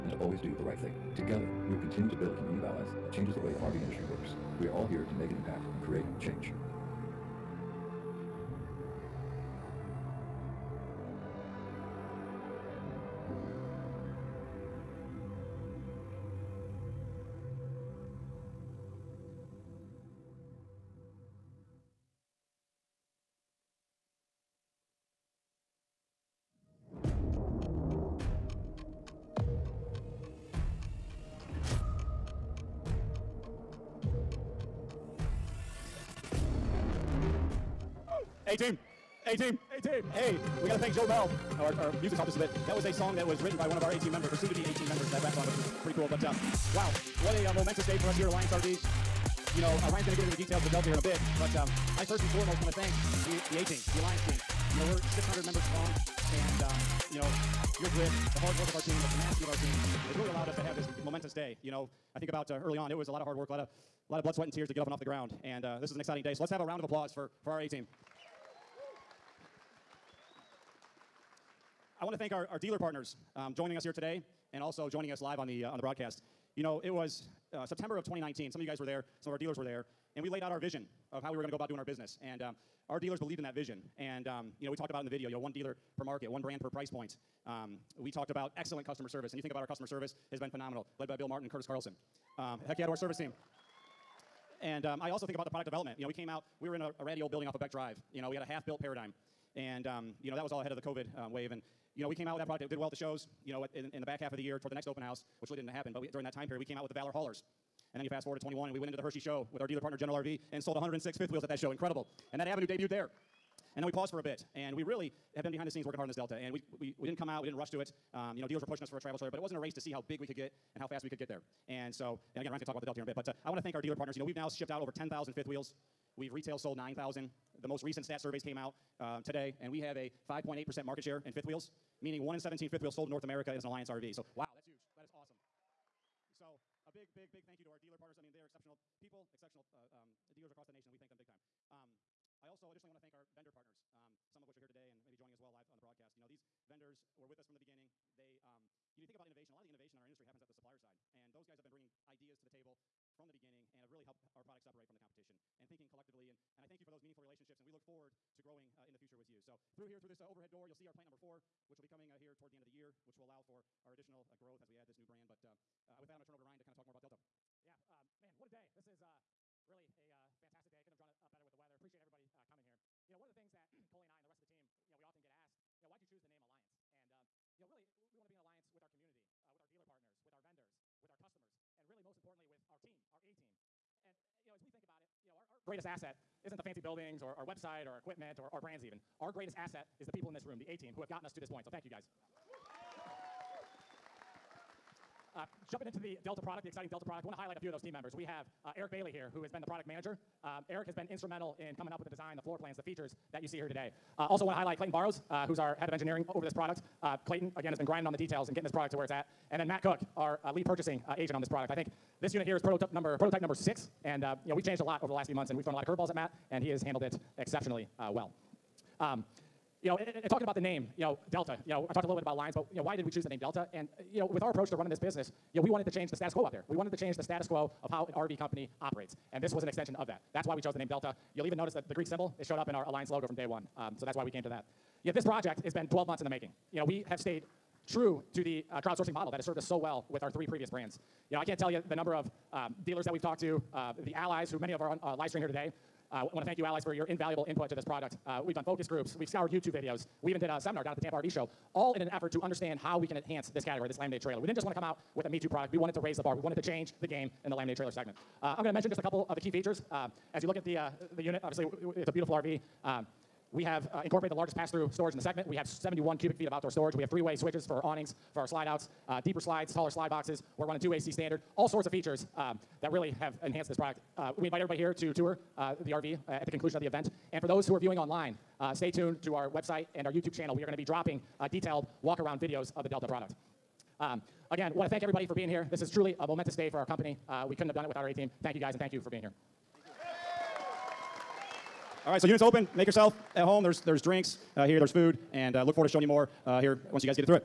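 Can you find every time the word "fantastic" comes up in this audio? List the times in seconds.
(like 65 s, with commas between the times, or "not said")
170 s.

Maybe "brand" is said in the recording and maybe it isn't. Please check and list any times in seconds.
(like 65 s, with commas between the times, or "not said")
86 s, 165 s, 188 s, 240 s.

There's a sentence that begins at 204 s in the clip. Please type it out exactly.
Uh, also want to highlight Clayton Barrows, uh, who's our head of engineering over this product.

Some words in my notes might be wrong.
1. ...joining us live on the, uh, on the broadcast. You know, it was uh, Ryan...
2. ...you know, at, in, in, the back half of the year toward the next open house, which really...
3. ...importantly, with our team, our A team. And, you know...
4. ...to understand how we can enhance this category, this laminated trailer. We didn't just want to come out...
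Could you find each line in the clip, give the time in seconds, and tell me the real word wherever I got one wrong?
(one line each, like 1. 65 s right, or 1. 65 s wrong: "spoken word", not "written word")
1. 74 s wrong: "September", not "Ryan"
2. 103 s right
3. 182 s right
4. 252 s right.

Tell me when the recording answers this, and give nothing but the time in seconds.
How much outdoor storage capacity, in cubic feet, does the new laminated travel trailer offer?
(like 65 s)
265 s.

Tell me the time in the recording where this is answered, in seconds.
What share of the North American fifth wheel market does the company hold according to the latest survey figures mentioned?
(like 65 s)
130 s.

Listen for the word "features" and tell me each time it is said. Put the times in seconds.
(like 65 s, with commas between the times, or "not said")
202 s, 259 s, 271 s.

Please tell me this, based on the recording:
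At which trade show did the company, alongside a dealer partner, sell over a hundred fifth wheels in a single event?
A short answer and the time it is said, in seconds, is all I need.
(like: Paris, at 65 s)
Hershey show, at 109 s.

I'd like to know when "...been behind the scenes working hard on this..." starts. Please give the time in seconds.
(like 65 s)
115 s.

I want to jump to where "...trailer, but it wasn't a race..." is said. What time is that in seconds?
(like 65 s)
119 s.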